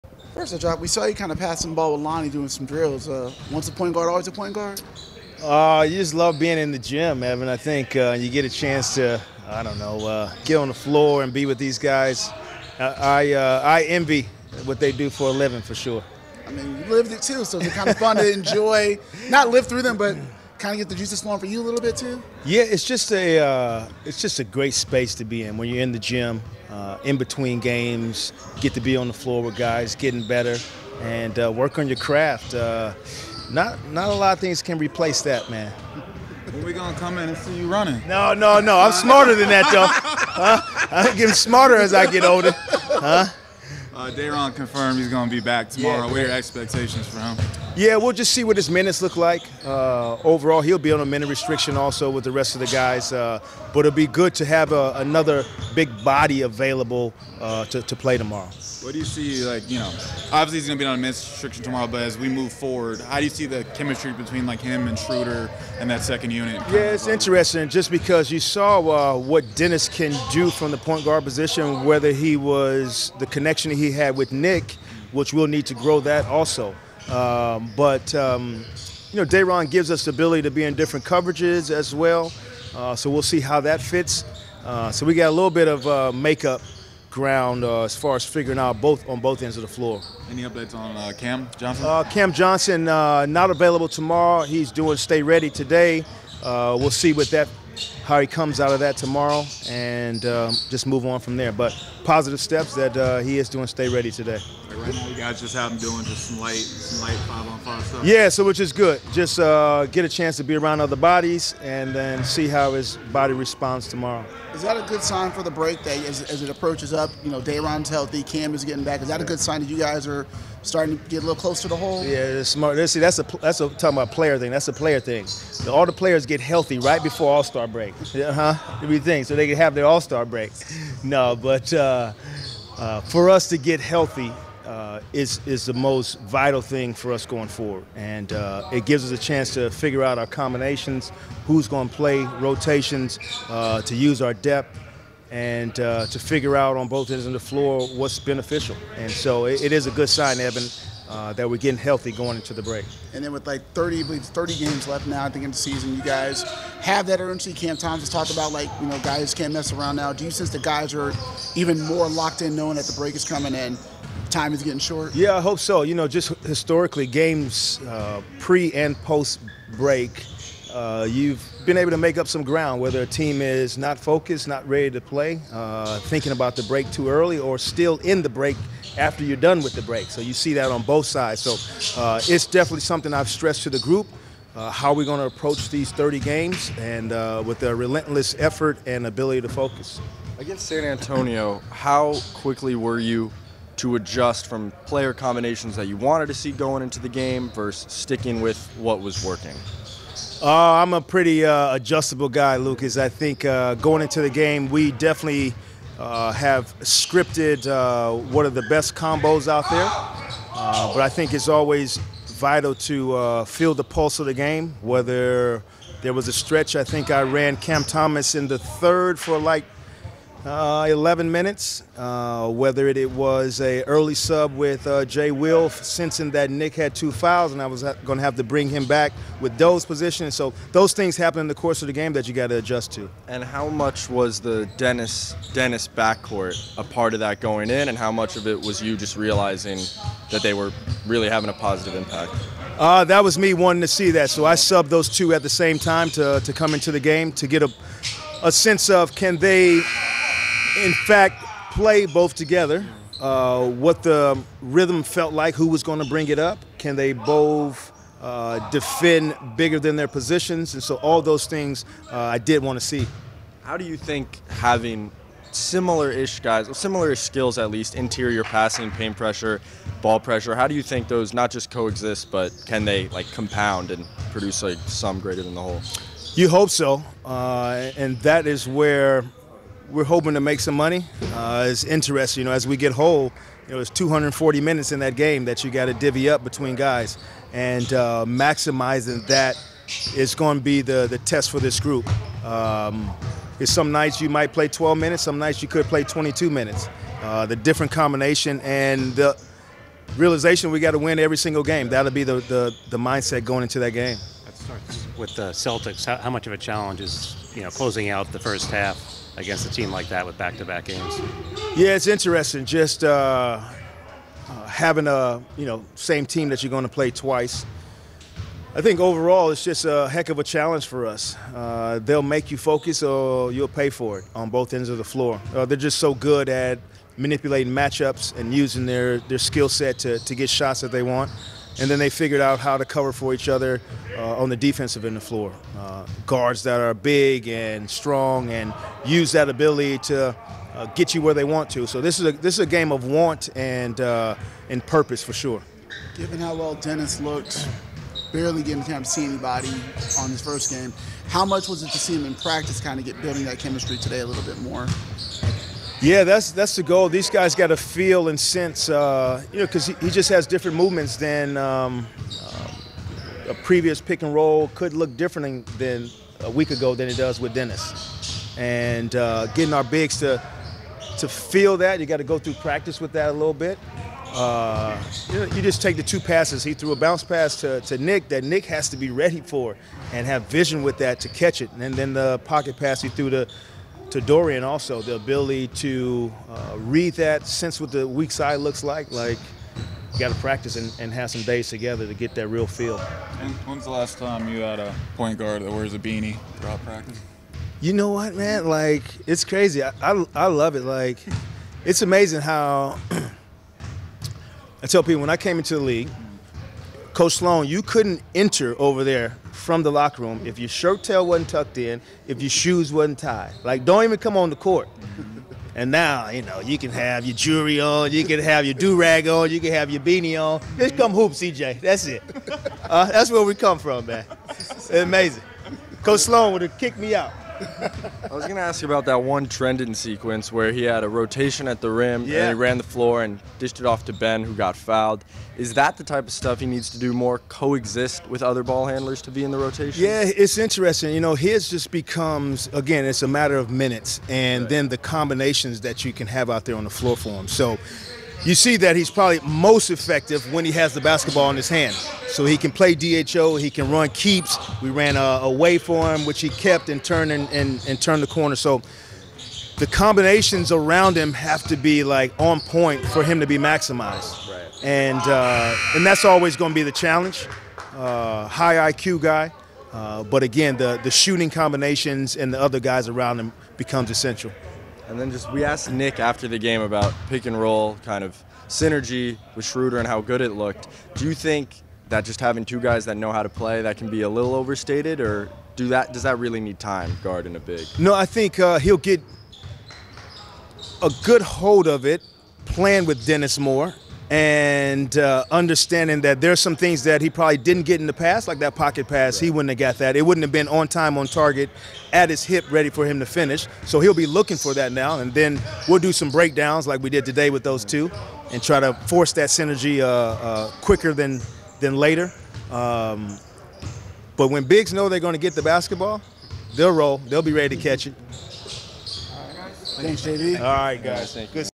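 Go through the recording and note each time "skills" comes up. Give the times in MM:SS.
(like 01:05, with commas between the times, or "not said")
04:27, 05:29.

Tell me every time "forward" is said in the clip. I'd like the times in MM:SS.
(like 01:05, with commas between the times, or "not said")
01:02, 02:17.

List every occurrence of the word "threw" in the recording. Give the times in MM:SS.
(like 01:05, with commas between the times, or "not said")
06:16, 06:23.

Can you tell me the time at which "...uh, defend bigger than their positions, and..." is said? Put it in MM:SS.
04:18.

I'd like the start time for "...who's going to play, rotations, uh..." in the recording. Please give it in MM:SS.
02:21.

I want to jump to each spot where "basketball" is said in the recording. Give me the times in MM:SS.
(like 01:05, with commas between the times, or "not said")
07:31, 08:35.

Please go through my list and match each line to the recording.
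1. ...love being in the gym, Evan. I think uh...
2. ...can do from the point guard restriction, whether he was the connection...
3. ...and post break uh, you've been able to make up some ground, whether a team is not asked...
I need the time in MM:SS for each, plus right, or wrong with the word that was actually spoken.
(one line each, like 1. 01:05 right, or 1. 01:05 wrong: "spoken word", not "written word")
1. 00:06 right
2. 01:09 wrong: "position", not "restriction"
3. 02:48 wrong: "focused", not "asked".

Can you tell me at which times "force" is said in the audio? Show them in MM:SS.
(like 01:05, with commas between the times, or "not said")
08:29.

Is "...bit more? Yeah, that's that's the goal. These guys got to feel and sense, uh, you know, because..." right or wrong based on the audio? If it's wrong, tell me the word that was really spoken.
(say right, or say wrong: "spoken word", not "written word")
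right.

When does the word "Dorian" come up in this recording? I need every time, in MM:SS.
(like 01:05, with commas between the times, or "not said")
06:24.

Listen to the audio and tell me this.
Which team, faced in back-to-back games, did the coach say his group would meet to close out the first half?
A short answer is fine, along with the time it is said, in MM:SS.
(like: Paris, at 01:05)
Celtics, at 05:05.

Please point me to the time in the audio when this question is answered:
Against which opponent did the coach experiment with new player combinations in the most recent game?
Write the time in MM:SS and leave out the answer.
03:10.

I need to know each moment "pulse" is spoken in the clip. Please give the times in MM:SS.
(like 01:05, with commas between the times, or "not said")
03:33.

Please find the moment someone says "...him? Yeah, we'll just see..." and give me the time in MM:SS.
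00:47.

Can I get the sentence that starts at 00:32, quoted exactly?
Uh, not not a lot of things can replace that, man.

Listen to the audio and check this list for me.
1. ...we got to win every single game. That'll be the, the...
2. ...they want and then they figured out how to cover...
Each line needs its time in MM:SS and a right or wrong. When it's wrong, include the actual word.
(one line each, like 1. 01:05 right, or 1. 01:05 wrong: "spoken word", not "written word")
1. 05:00 right
2. 05:30 right.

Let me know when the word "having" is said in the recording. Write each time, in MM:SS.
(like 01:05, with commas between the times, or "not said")
04:01, 04:24, 05:14, 08:02.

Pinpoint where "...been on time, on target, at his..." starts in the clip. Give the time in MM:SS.
08:20.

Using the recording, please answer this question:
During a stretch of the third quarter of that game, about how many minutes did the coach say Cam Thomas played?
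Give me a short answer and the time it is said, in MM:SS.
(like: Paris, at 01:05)
11, at 03:40.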